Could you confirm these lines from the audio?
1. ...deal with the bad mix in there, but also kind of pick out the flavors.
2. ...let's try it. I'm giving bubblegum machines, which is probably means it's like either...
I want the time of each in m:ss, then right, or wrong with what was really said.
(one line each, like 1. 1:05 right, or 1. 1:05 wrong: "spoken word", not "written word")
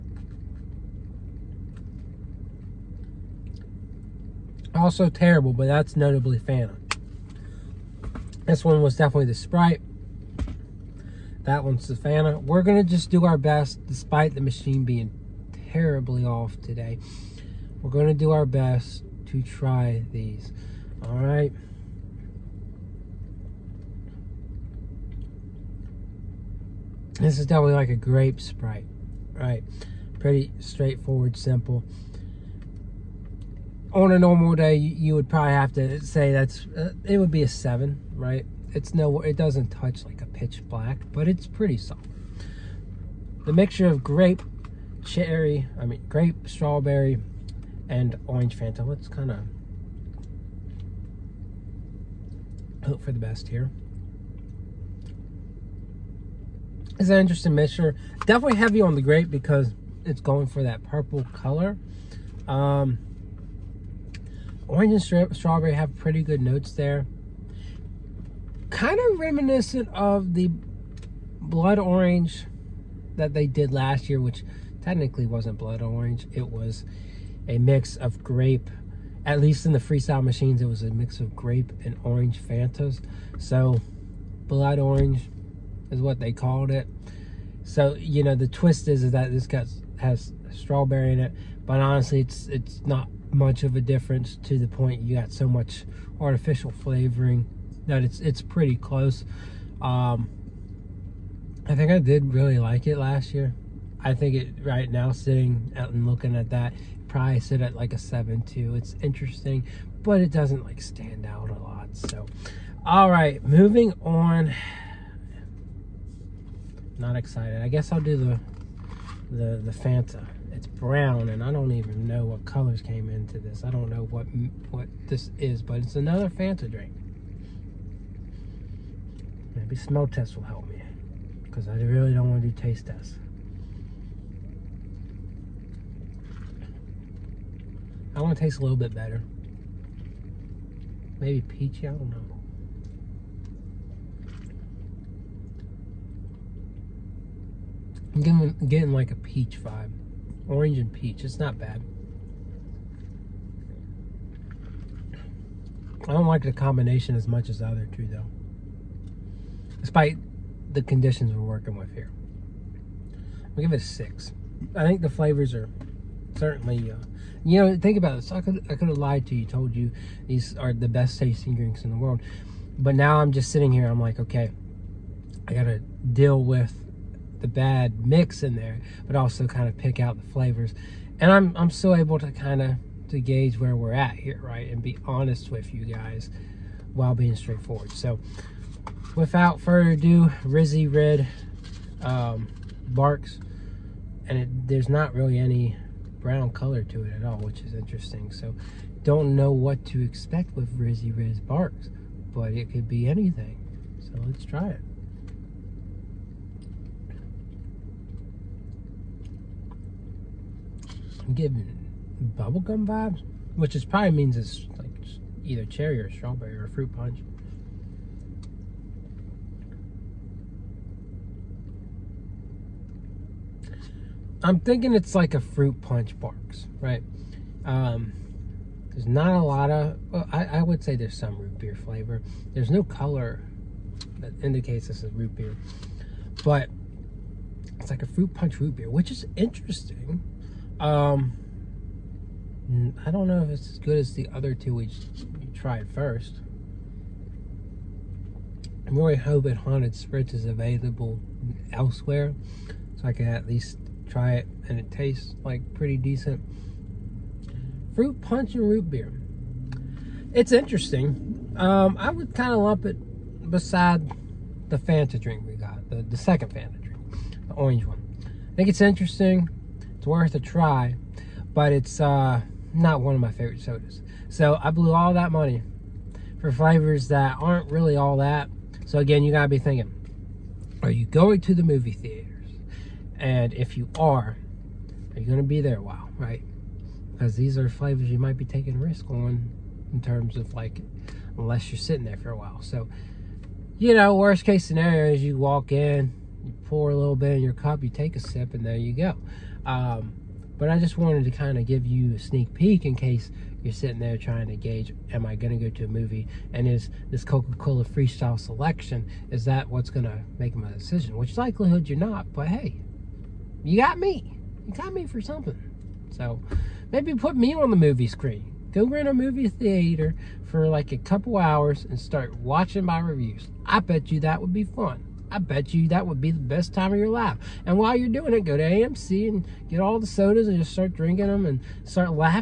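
1. 2:55 right
2. 3:24 wrong: "vibes", not "machines".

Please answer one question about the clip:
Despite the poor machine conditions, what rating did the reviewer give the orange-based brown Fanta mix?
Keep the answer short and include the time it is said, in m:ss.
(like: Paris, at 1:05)
6, at 2:43.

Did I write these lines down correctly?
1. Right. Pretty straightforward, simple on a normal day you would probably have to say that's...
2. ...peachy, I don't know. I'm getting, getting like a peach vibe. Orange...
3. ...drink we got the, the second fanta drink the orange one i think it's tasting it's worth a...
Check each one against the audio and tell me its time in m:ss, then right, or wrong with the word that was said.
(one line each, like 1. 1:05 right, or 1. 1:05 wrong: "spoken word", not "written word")
1. 0:29 right
2. 2:21 right
3. 4:25 wrong: "interesting", not "tasting".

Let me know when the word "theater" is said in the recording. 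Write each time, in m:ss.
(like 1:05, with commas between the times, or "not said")
4:41, 5:19.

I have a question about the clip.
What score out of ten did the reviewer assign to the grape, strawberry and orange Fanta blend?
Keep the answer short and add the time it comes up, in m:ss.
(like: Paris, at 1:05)
7.2, at 1:47.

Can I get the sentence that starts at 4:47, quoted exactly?
Because these are flavors you might be taking a risk on in terms of like, unless you're sitting there for a while.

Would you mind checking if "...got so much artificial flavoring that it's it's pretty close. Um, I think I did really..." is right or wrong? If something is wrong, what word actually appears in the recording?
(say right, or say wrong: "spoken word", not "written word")
right.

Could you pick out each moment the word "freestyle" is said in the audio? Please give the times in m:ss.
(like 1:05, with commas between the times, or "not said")
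1:19, 5:07.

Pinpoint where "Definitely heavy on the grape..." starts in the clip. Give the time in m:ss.
0:58.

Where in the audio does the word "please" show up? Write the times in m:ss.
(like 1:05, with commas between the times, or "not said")
not said.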